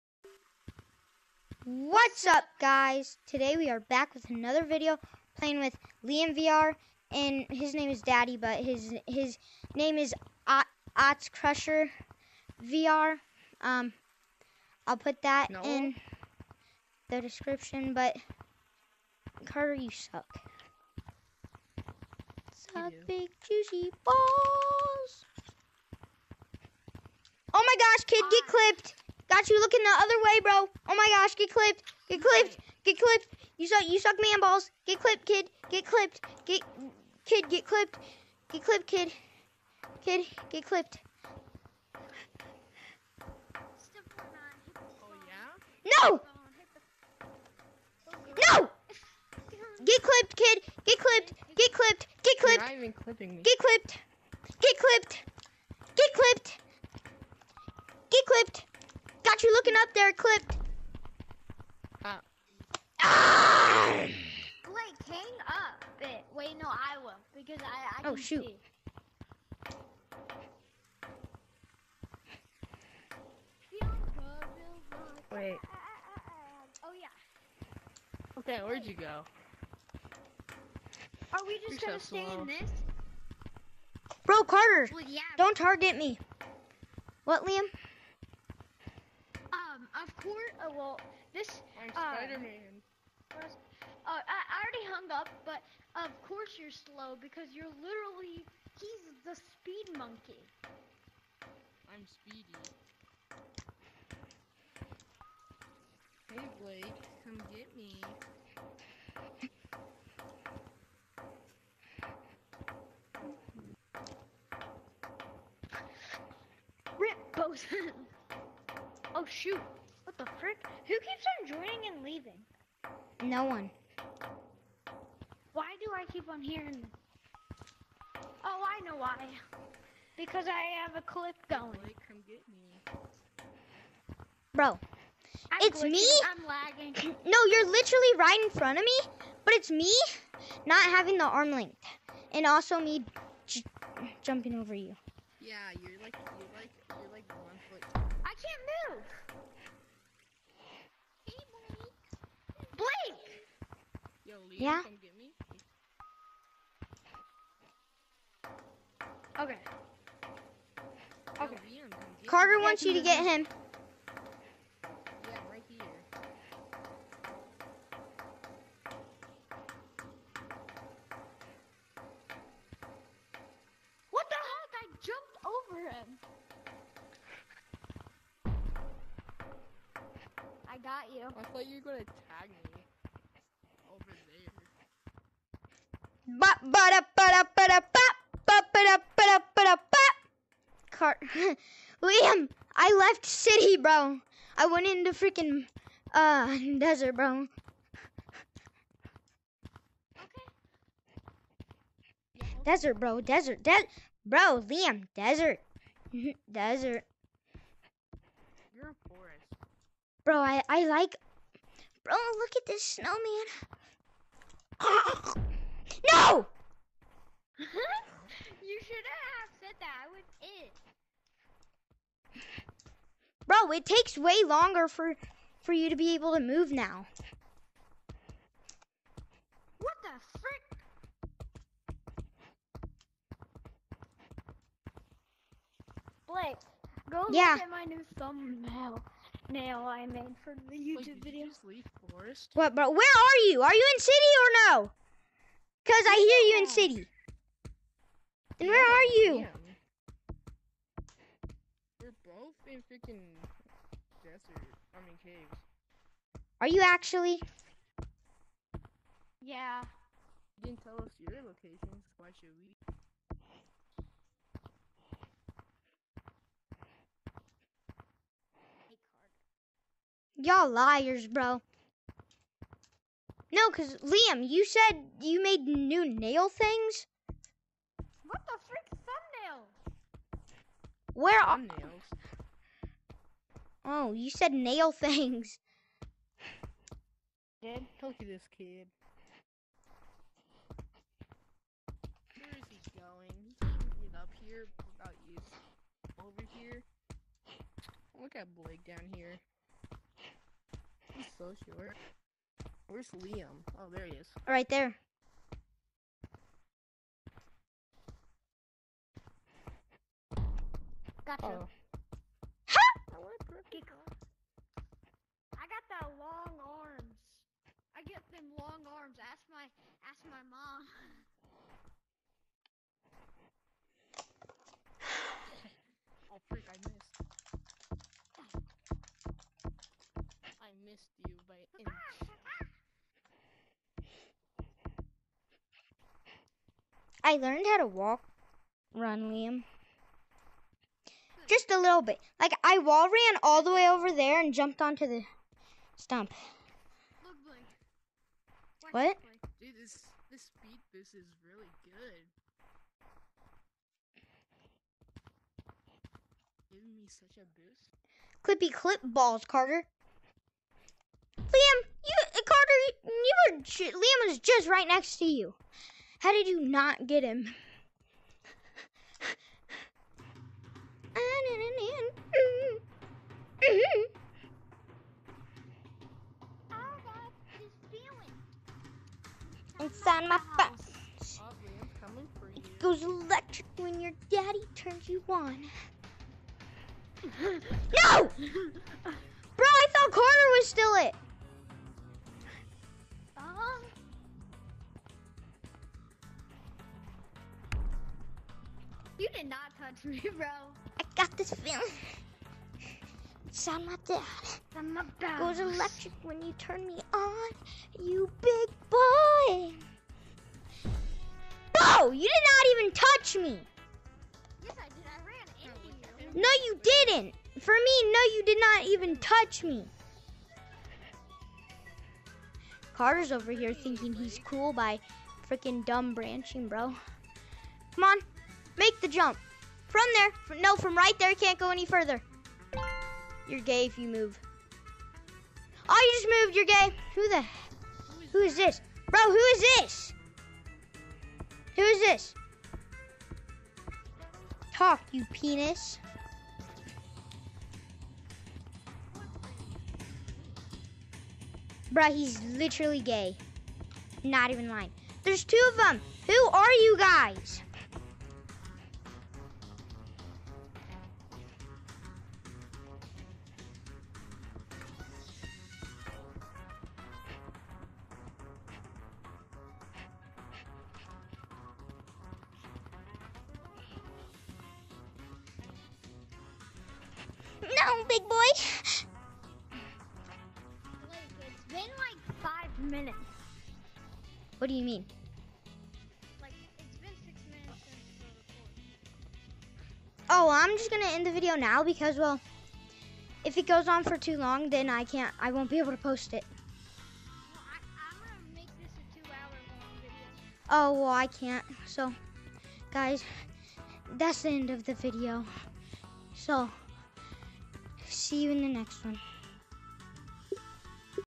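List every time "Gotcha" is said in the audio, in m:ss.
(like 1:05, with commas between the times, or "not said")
5:11.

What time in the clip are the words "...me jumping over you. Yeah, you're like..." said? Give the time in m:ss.
2:22.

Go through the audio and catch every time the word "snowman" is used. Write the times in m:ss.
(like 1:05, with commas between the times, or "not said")
3:32.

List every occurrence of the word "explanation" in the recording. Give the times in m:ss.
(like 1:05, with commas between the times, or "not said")
not said.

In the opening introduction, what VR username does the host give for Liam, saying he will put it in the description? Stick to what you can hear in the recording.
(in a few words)
Ots Crusher VR.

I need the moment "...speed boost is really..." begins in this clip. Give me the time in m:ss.
5:50.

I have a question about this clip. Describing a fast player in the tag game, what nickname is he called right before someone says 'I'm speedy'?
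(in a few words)
Speed monkey.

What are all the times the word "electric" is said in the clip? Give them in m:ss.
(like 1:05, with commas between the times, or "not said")
6:23, 6:45.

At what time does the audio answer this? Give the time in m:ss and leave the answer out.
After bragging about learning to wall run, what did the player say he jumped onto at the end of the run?
5:45.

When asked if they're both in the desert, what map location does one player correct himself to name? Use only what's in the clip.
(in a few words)
Caves.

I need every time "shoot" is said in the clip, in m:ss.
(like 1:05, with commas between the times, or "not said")
1:08, 1:59.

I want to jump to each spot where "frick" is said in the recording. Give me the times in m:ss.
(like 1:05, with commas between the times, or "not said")
2:00, 3:50.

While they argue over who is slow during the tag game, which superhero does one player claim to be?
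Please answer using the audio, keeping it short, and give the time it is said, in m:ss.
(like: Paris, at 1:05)
Spider-Man, at 1:32.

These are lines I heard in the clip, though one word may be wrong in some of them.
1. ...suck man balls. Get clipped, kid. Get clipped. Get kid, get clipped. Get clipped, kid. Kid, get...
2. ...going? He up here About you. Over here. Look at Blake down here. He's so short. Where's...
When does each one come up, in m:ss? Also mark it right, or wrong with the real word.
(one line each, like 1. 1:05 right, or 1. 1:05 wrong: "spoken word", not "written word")
1. 0:33 right
2. 4:52 right.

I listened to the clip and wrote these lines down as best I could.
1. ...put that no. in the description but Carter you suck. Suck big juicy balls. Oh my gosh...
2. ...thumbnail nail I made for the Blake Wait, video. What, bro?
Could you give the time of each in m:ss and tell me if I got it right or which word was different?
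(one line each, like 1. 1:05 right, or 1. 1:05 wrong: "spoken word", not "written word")
1. 0:14 right
2. 3:58 wrong: "YouTube", not "Blake".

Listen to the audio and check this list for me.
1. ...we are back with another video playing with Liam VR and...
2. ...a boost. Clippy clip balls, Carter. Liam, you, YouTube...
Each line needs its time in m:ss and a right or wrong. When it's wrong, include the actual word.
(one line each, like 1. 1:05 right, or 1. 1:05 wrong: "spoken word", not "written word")
1. 0:03 right
2. 5:57 wrong: "Carter", not "YouTube".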